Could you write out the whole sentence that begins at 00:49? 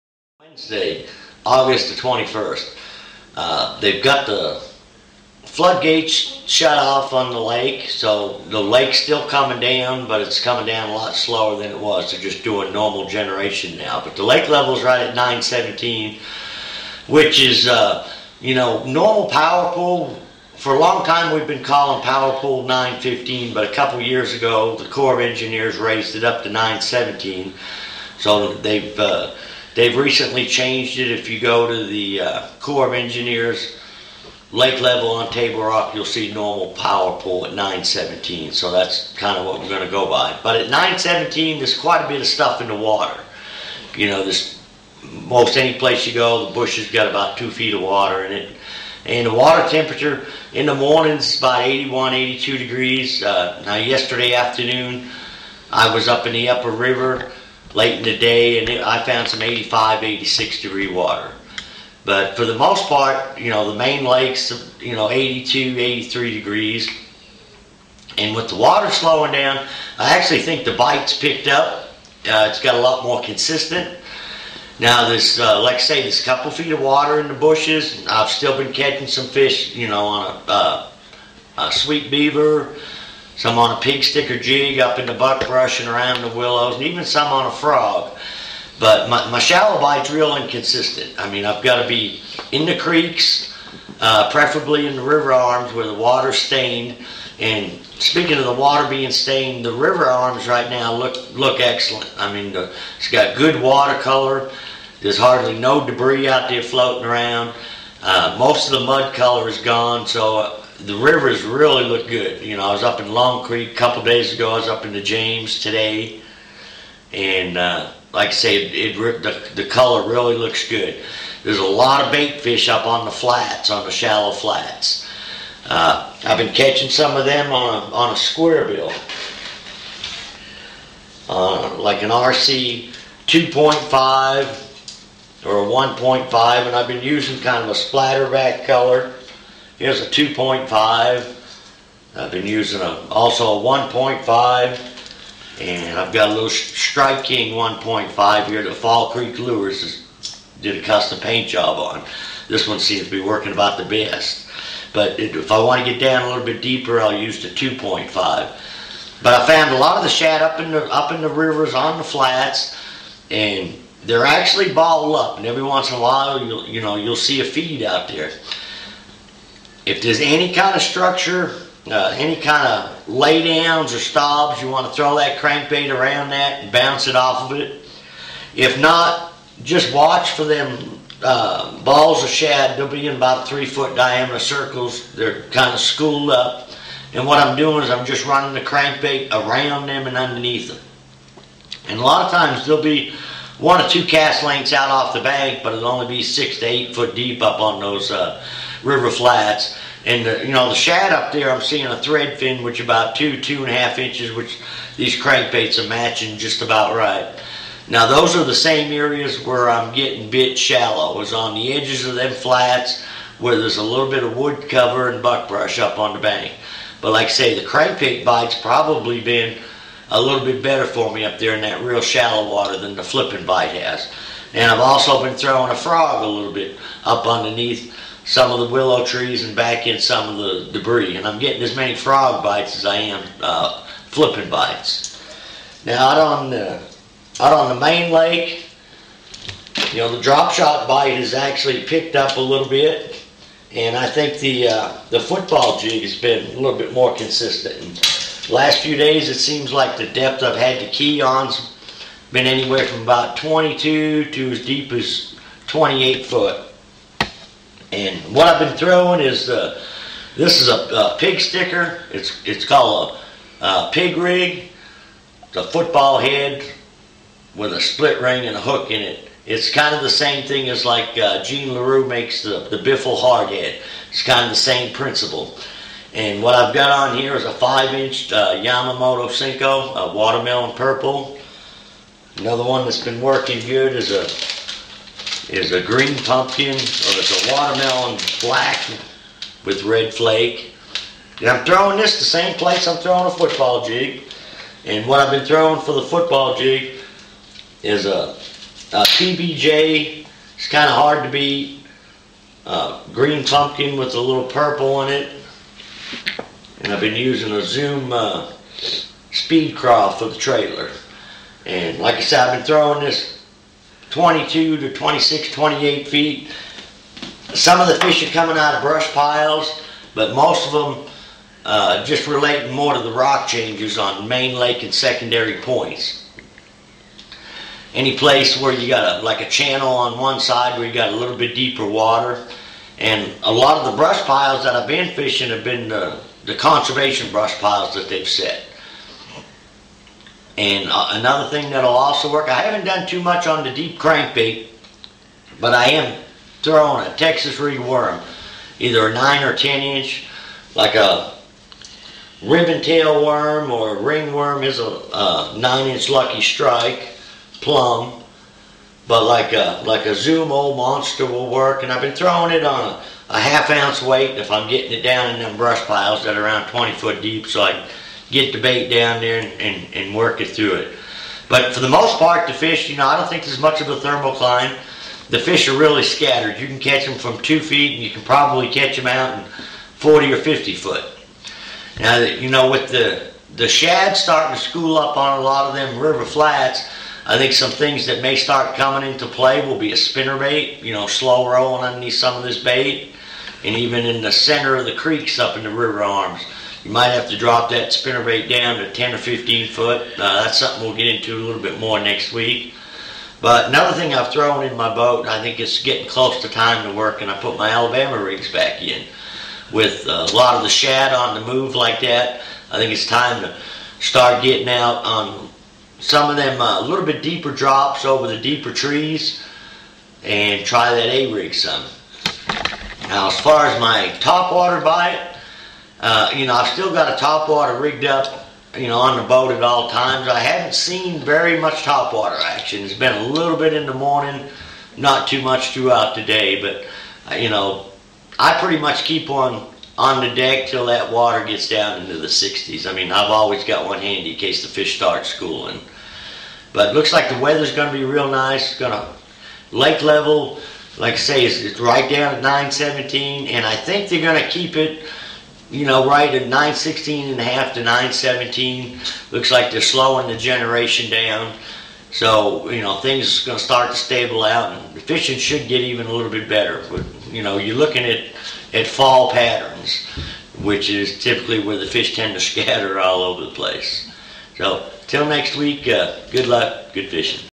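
And the water temperature in the mornings about 81, 82 degrees.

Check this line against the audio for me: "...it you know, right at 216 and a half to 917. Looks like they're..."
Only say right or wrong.
wrong.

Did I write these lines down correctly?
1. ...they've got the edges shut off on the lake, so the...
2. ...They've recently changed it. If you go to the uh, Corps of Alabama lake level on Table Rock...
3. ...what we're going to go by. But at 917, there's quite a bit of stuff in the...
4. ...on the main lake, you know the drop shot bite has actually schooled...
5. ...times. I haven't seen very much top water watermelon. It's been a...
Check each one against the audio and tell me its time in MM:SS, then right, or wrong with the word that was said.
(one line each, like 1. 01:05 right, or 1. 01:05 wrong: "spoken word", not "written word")
1. 00:03 wrong: "floodgates", not "edges"
2. 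00:29 wrong: "Engineers", not "Alabama"
3. 00:39 right
4. 03:57 wrong: "picked", not "schooled"
5. 07:09 wrong: "action", not "watermelon".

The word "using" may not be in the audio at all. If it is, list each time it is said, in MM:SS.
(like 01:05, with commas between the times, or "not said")
02:17, 02:22, 05:07.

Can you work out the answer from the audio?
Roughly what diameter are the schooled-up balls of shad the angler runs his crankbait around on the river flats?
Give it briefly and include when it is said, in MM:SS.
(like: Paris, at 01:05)
3 feet, at 03:03.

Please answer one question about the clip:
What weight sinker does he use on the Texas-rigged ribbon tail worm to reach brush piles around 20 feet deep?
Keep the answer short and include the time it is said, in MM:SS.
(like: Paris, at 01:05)
Half ounce, at 06:03.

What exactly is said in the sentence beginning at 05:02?
Uh, green pumpkin with a little purple in it.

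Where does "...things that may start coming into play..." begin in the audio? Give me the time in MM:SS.
06:27.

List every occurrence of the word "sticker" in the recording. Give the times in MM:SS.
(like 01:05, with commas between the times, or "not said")
01:24, 04:21.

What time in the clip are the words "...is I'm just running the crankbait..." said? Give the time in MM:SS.
03:07.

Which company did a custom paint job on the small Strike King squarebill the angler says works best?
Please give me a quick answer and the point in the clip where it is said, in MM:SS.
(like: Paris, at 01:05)
Fall Creek Lures, at 02:28.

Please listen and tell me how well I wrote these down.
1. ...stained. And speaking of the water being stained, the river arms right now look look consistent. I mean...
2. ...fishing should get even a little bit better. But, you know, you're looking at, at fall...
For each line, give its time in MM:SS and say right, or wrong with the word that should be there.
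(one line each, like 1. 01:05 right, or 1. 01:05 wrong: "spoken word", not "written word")
1. 01:36 wrong: "excellent", not "consistent"
2. 07:44 right.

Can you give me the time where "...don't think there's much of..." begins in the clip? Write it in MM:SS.
06:13.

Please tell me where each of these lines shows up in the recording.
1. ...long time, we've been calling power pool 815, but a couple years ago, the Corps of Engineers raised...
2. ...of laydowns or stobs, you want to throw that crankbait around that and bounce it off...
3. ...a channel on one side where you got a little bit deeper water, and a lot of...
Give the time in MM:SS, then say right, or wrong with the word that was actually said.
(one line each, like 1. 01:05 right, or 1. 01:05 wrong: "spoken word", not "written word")
1. 00:20 wrong: "915", not "815"
2. 02:52 right
3. 05:29 right.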